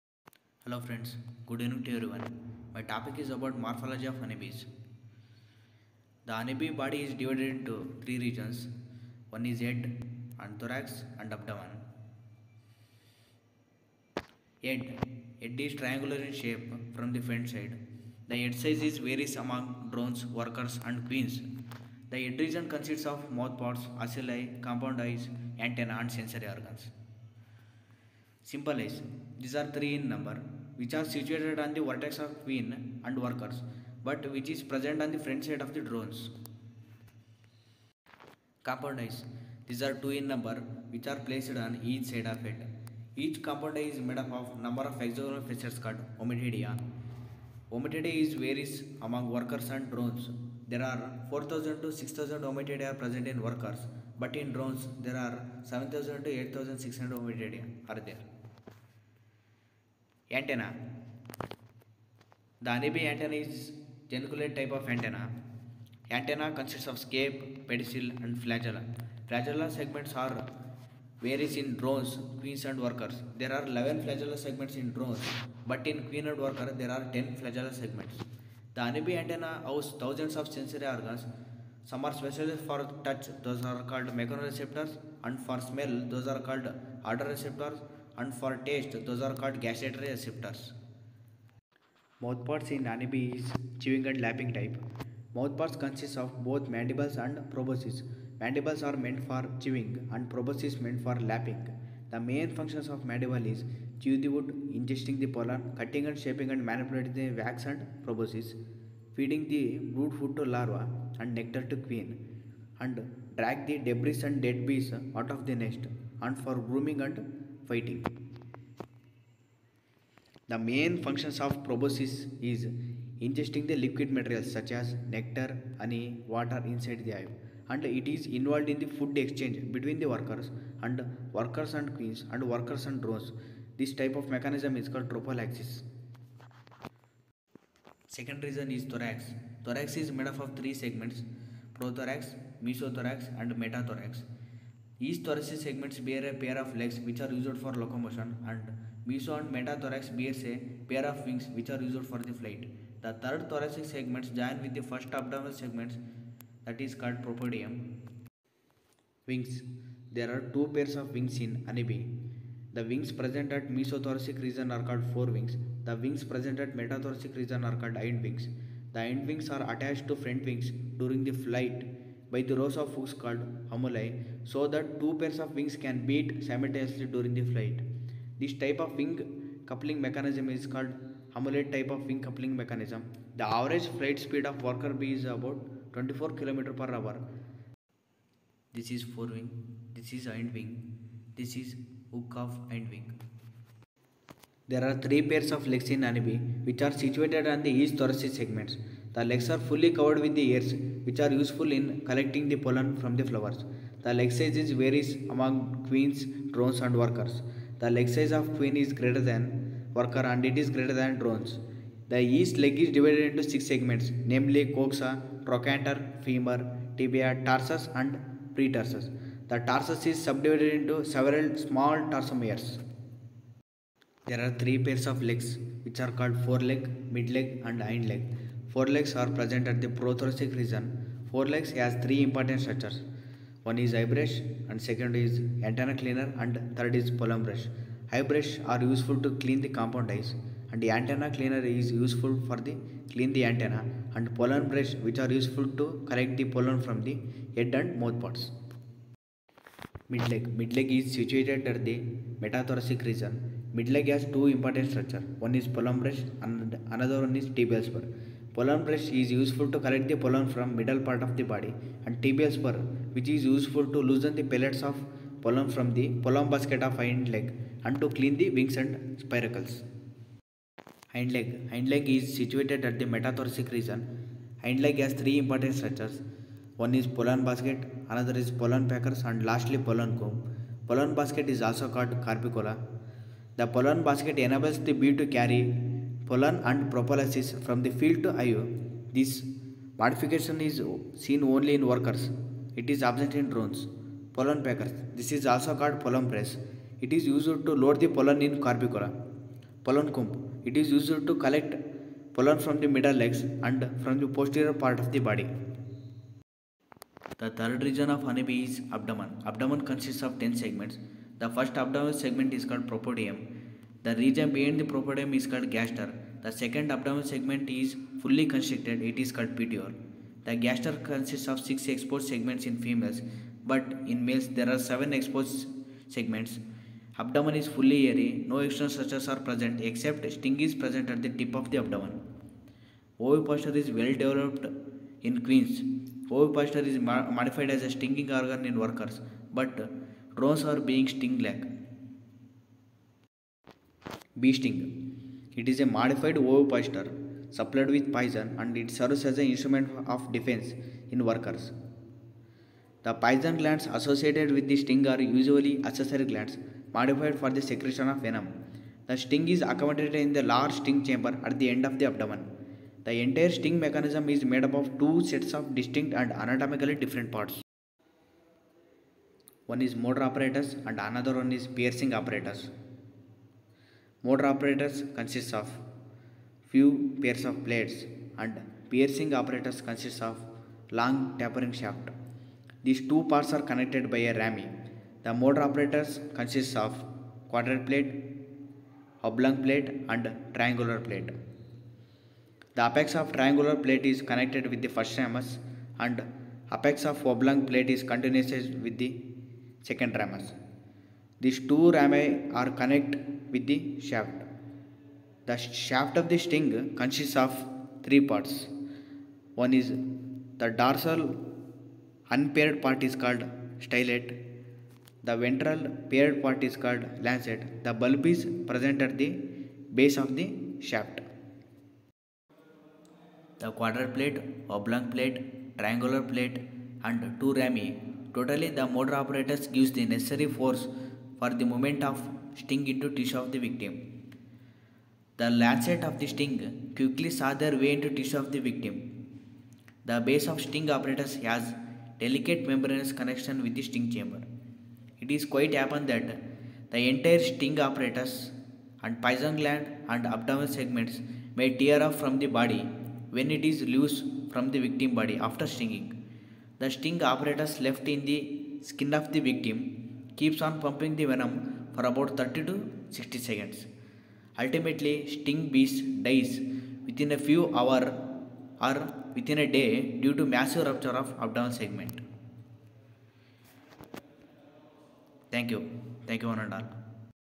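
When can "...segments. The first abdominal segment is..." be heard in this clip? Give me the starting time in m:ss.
5:10.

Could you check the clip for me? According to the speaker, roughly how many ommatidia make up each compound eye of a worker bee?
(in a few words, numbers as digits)
4000 to 6000.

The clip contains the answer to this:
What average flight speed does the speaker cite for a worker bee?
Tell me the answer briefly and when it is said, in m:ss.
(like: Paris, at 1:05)
24 km per hour, at 3:05.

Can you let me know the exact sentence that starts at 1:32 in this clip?
Mouthparts in honeybee is chewing and lapping type.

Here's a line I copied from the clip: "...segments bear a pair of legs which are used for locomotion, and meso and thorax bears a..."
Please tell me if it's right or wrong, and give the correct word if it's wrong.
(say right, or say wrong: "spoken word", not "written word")
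wrong: "metathorax", not "thorax".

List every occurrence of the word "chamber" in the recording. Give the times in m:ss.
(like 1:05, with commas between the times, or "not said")
6:01, 7:24.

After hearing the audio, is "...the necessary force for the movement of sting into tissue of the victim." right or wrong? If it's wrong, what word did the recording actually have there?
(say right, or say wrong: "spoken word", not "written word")
right.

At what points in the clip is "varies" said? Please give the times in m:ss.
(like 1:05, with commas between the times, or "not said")
0:18, 0:48, 1:11, 3:24.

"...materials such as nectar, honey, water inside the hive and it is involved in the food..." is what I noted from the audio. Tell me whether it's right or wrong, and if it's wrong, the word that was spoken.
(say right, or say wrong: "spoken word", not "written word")
right.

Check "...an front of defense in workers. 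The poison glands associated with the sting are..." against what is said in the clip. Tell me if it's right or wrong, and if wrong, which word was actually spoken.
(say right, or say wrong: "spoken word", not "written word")
wrong: "instrument", not "front".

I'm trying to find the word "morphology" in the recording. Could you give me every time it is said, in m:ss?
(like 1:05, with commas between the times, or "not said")
0:03.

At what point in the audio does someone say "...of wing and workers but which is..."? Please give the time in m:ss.
0:32.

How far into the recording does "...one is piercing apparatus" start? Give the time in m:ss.
6:11.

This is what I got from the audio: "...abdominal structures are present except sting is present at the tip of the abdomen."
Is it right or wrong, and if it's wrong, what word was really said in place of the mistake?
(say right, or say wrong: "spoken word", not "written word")
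wrong: "external", not "abdominal".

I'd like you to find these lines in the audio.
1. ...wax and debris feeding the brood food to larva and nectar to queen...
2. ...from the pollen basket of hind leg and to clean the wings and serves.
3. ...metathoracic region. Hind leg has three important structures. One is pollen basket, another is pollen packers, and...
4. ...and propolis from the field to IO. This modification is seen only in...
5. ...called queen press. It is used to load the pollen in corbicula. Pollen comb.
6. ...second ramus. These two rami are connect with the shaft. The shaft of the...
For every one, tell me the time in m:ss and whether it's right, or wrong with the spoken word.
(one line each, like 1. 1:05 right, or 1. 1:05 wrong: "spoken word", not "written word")
1. 1:47 wrong: "proboscis", not "debris"
2. 4:25 wrong: "spiracles", not "serves"
3. 4:33 right
4. 4:46 right
5. 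4:55 wrong: "pollen", not "queen"
6. 6:39 right.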